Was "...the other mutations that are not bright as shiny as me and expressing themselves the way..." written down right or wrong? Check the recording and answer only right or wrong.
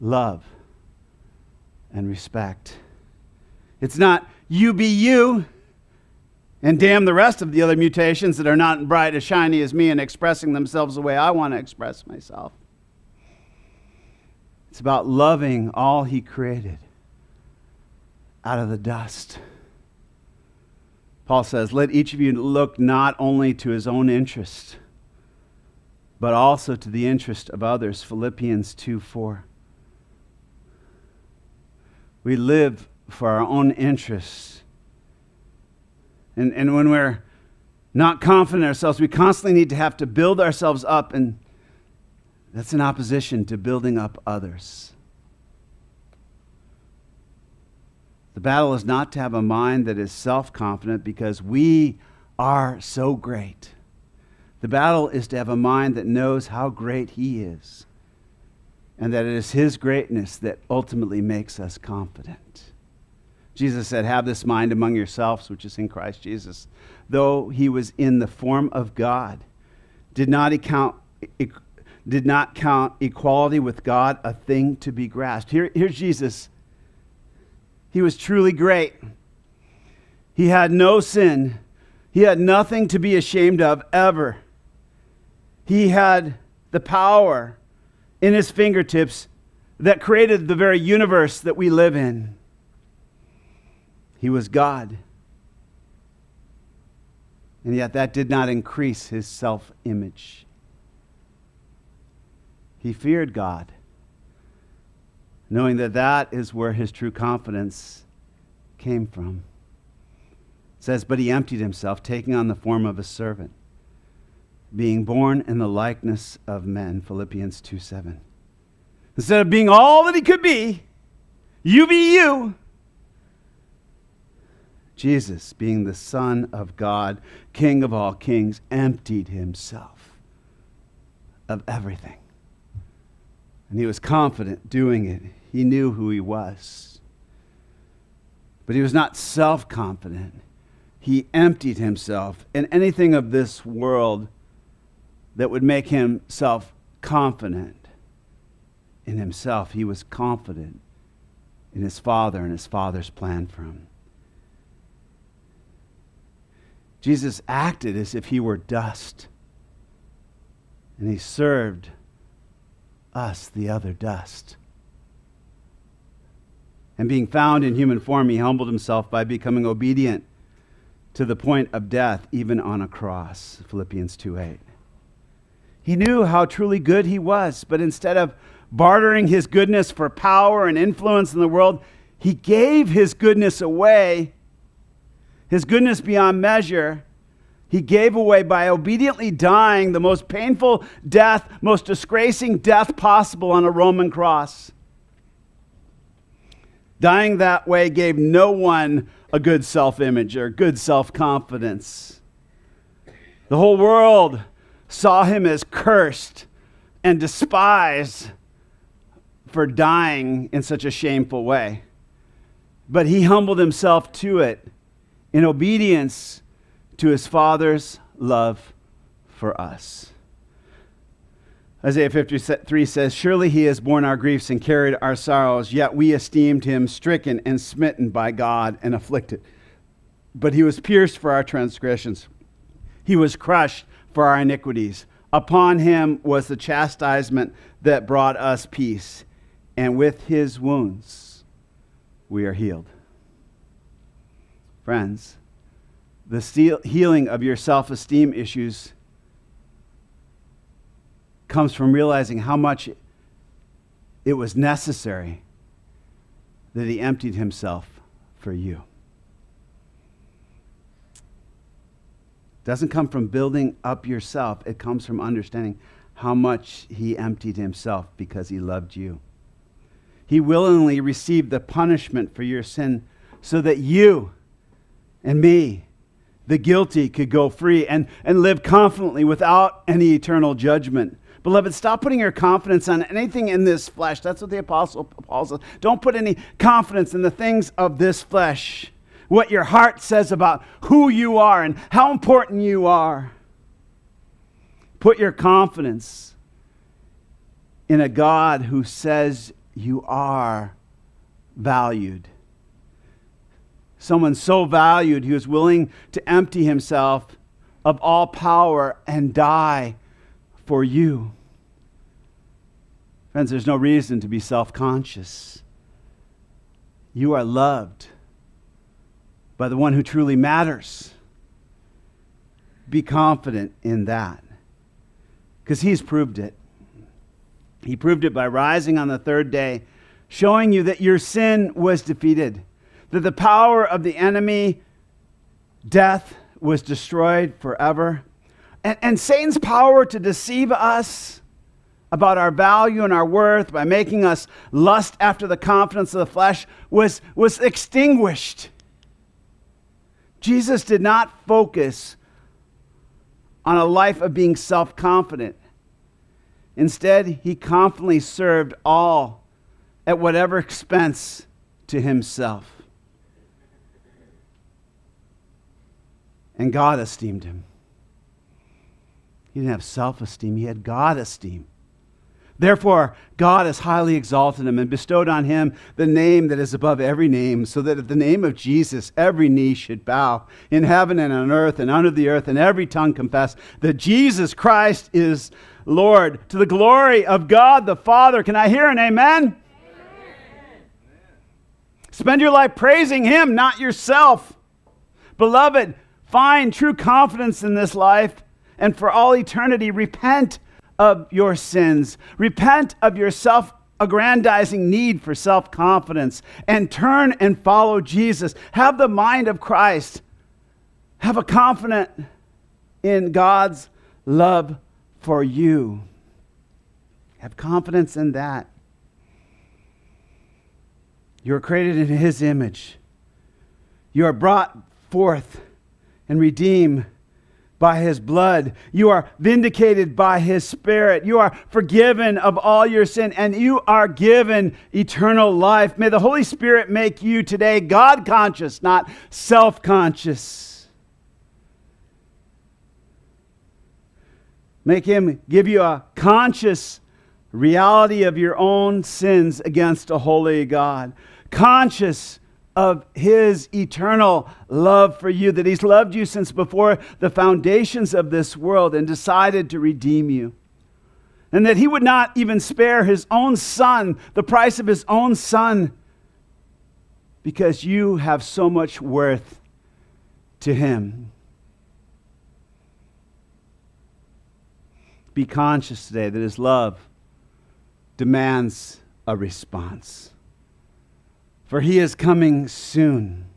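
right.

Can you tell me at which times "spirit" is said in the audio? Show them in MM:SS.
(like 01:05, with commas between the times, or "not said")
07:10, 07:16.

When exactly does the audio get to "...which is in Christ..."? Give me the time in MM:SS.
01:05.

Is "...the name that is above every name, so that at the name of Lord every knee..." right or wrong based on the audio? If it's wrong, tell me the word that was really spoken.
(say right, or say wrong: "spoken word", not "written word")
wrong: "Jesus", not "Lord".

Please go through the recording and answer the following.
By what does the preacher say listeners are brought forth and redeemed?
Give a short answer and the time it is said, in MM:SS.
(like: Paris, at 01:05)
his blood, at 07:07.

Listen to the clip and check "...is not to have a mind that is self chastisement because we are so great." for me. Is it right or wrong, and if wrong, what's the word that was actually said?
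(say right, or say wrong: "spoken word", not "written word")
wrong: "confident", not "chastisement".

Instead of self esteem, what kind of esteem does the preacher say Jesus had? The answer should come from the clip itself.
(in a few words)
God esteem.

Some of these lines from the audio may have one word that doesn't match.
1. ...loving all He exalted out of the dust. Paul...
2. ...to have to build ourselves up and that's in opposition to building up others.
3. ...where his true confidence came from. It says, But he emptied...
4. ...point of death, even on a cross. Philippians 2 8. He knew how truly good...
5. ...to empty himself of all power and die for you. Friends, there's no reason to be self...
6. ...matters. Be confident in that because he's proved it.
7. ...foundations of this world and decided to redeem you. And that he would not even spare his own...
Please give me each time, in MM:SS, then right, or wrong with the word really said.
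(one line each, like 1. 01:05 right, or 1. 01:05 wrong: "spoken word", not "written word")
1. 00:15 wrong: "created", not "exalted"
2. 00:39 right
3. 01:46 right
4. 02:51 right
5. 05:06 right
6. 05:20 right
7. 07:37 right.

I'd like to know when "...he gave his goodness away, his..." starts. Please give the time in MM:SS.
03:02.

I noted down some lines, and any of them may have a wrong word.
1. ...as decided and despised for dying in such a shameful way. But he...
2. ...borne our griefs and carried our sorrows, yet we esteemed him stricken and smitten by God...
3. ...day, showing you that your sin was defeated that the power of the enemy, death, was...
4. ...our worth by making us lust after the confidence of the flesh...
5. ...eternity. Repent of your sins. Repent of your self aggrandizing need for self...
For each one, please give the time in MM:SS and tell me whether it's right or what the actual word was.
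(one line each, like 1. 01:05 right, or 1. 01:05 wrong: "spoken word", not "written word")
1. 03:25 wrong: "cursed", not "decided"
2. 03:43 right
3. 05:29 right
4. 05:43 right
5. 06:39 right.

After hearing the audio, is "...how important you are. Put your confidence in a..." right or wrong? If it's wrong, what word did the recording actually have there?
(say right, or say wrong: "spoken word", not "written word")
right.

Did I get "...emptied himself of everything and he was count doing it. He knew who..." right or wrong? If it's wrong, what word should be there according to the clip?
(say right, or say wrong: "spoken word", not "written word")
wrong: "confident", not "count".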